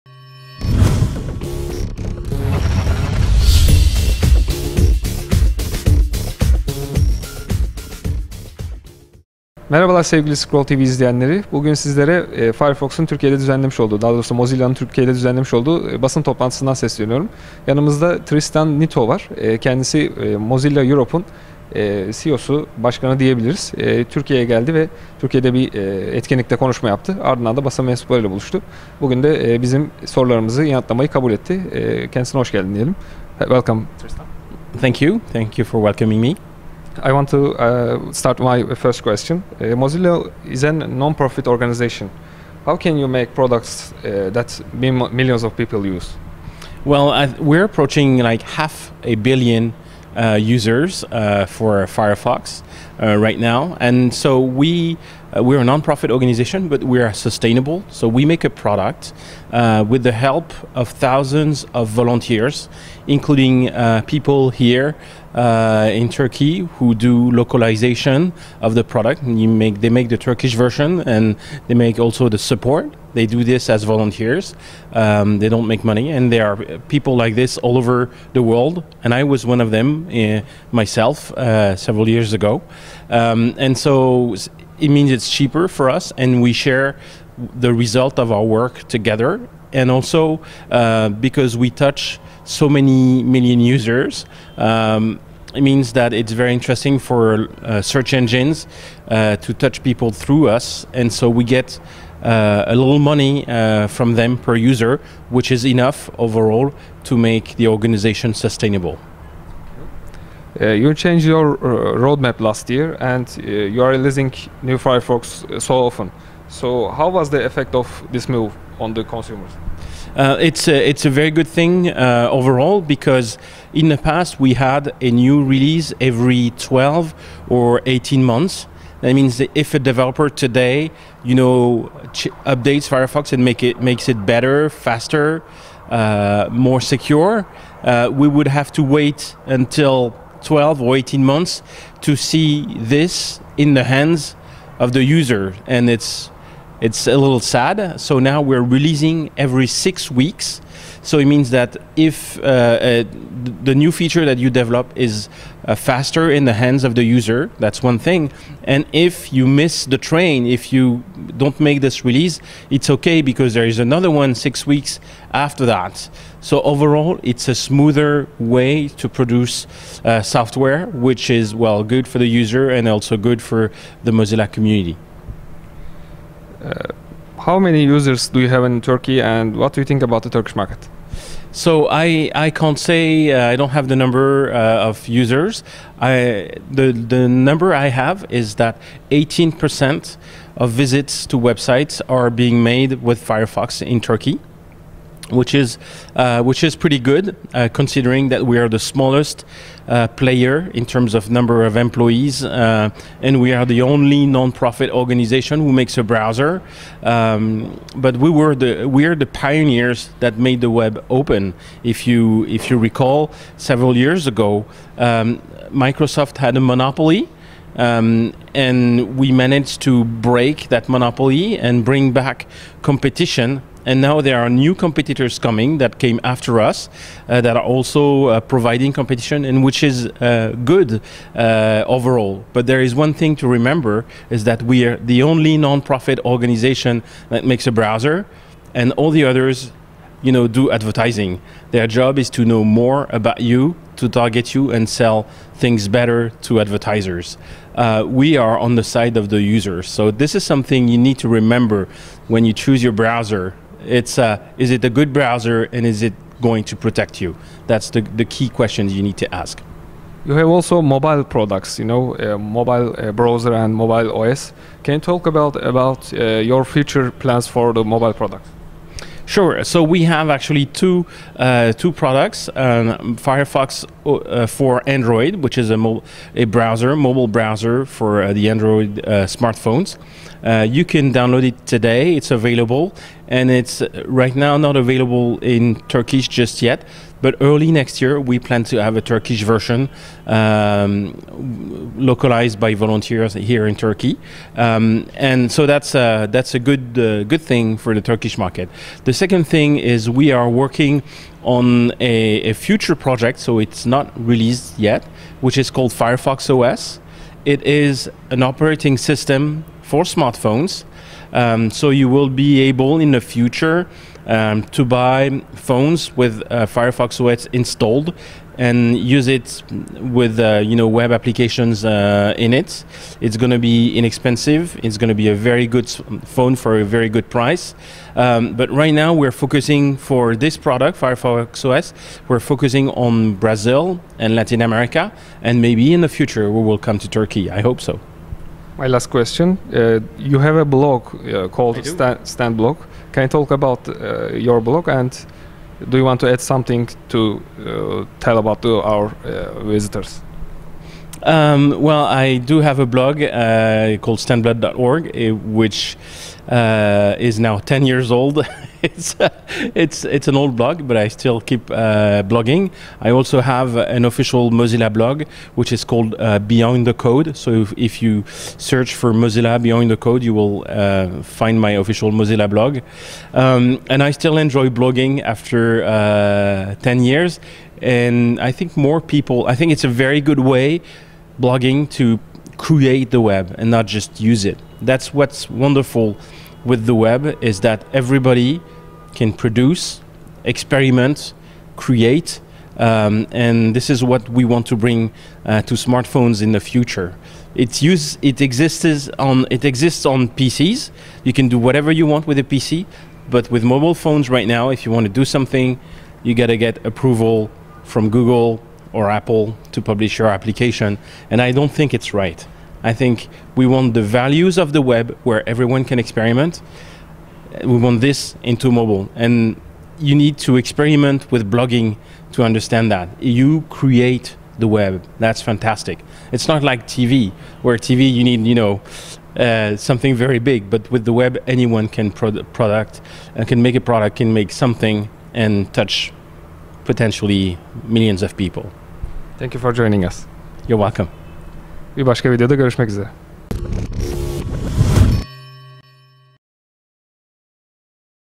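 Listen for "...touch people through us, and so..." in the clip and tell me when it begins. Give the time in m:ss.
1:39.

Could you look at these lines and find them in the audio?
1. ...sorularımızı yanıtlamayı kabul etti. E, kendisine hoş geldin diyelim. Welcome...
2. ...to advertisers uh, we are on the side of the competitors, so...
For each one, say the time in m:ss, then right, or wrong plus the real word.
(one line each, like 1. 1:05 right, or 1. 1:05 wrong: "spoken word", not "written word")
1. 0:30 right
2. 4:06 wrong: "users", not "competitors".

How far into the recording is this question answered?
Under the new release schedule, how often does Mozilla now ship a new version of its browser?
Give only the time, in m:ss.
2:29.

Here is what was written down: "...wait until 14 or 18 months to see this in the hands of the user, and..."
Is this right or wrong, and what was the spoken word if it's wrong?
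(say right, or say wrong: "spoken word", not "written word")
wrong: "12", not "14".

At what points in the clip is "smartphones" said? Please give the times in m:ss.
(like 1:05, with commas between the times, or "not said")
4:39, 5:10, 6:35.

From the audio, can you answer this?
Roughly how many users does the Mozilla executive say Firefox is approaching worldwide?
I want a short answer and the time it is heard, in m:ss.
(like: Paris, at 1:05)
half a billion, at 0:48.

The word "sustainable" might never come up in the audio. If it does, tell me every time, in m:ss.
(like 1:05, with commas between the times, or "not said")
0:57, 1:48.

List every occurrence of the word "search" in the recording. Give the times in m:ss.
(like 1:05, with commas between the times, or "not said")
1:37, 6:08.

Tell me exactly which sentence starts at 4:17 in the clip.
That's the, the key questions you need to ask.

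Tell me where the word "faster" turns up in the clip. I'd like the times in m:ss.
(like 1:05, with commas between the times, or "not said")
2:14, 2:35.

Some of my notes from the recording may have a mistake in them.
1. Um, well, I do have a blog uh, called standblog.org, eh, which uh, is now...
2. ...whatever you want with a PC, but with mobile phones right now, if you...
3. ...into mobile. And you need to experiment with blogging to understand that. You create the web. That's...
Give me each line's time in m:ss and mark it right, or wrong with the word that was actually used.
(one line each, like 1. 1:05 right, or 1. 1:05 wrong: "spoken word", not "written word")
1. 5:51 right
2. 6:41 right
3. 6:58 right.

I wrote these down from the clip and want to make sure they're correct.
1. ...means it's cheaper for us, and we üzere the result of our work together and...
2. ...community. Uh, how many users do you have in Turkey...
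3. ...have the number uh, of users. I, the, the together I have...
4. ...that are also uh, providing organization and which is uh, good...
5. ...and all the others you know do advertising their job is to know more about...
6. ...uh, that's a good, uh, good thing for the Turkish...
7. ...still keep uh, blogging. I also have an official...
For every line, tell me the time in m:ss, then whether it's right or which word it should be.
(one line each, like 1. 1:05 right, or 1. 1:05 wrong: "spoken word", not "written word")
1. 1:24 wrong: "share", not "üzere"
2. 2:54 right
3. 3:03 wrong: "number", not "together"
4. 3:47 wrong: "competition", not "organization"
5. 3:58 right
6. 4:55 right
7. 6:01 right.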